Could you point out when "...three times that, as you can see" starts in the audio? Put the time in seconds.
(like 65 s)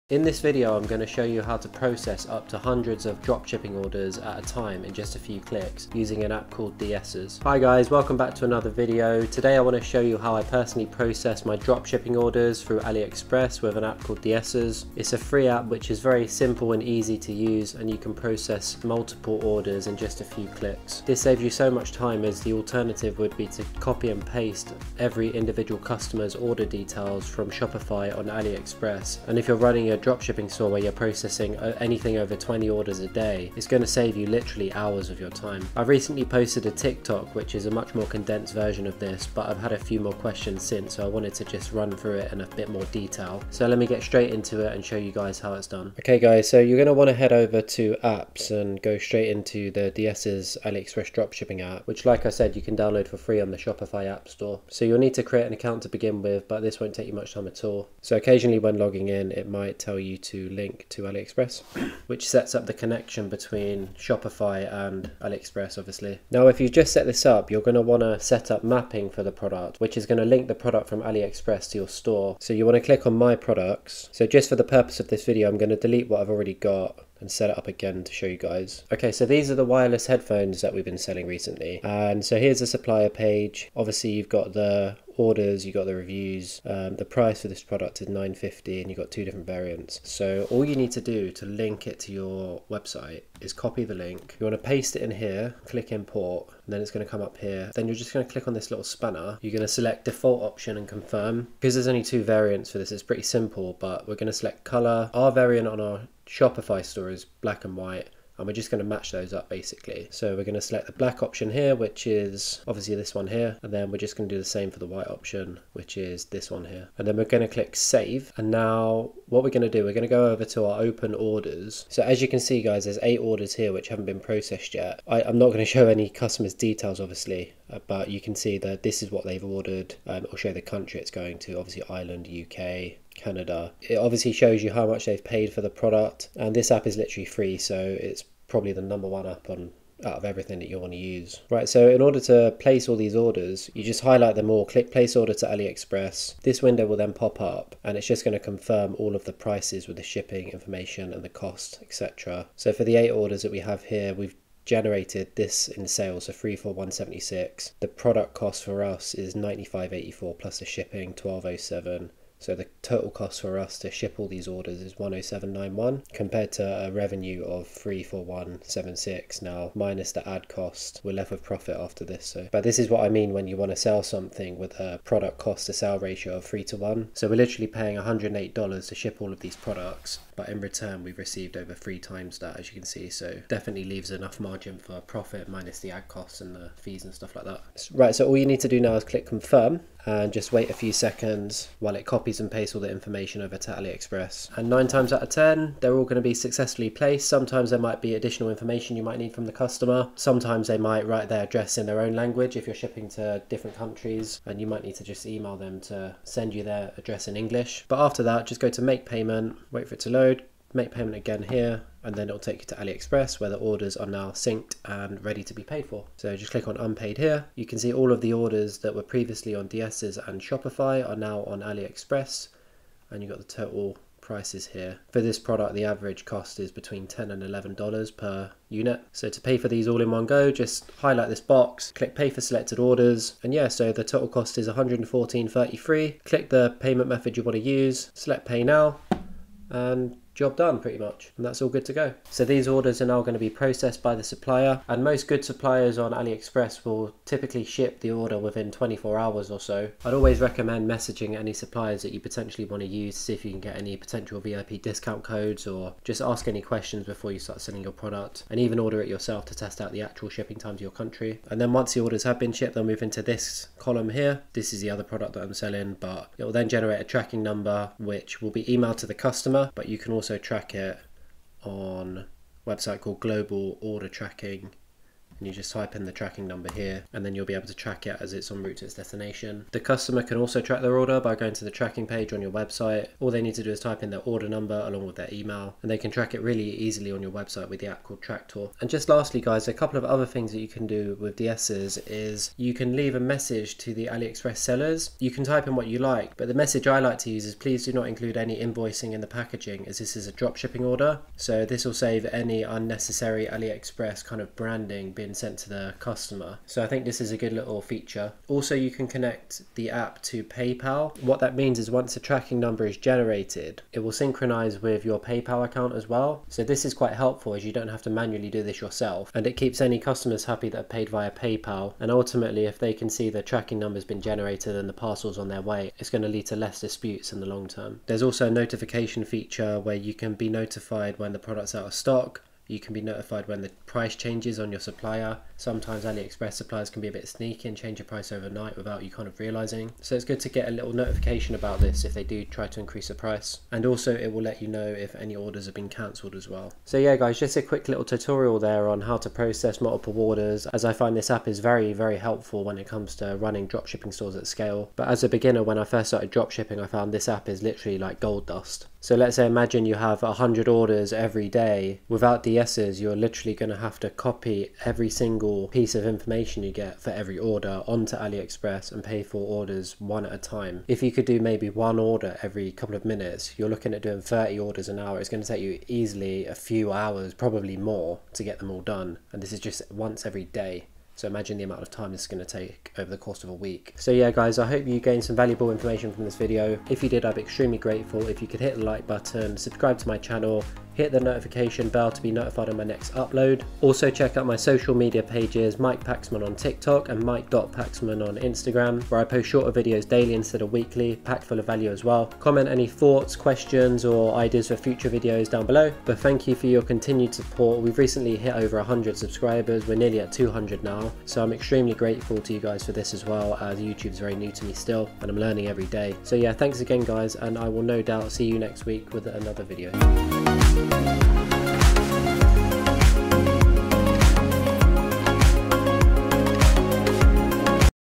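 181 s.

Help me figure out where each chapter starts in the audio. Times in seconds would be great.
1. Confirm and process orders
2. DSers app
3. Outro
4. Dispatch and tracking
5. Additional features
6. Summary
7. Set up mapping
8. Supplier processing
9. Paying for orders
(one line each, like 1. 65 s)
1. 117 s
2. 45 s
3. 383 s
4. 266 s
5. 288 s
6. 346 s
7. 66 s
8. 242 s
9. 227 s.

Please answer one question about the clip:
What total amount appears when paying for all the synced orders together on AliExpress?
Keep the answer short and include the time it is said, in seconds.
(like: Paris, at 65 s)
114.33, at 234 s.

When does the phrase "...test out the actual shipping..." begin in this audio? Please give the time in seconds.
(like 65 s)
259 s.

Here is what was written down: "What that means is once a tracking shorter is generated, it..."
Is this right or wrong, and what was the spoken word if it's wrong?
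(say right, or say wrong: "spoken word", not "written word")
wrong: "number", not "shorter".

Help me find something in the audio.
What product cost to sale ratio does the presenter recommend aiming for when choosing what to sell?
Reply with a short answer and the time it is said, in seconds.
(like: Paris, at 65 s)
3 to 1, at 176 s.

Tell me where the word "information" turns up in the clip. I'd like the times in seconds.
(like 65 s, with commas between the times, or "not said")
150 s, 192 s, 198 s, 366 s, 385 s.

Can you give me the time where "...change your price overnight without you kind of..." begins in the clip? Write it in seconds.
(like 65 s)
337 s.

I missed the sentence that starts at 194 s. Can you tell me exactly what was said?
And nine times out of 10, they're all gonna be successfully placed.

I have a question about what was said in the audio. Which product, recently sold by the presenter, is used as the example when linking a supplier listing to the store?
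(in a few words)
Wireless headphones.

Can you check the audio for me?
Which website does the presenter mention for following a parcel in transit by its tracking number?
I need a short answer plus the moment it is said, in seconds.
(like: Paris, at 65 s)
Global Order Tracking, at 273 s.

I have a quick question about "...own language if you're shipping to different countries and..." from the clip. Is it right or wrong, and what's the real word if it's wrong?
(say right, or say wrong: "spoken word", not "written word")
right.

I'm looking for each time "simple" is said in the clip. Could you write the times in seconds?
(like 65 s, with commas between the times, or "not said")
16 s, 103 s.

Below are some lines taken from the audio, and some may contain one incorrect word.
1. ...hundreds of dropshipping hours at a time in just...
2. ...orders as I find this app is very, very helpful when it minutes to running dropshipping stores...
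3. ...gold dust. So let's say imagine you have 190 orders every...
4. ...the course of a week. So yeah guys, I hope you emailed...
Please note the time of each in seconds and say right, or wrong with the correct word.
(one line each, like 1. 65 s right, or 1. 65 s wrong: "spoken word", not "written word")
1. 2 s wrong: "orders", not "hours"
2. 350 s wrong: "comes", not "minutes"
3. 358 s wrong: "100", not "190"
4. 383 s wrong: "gained", not "emailed".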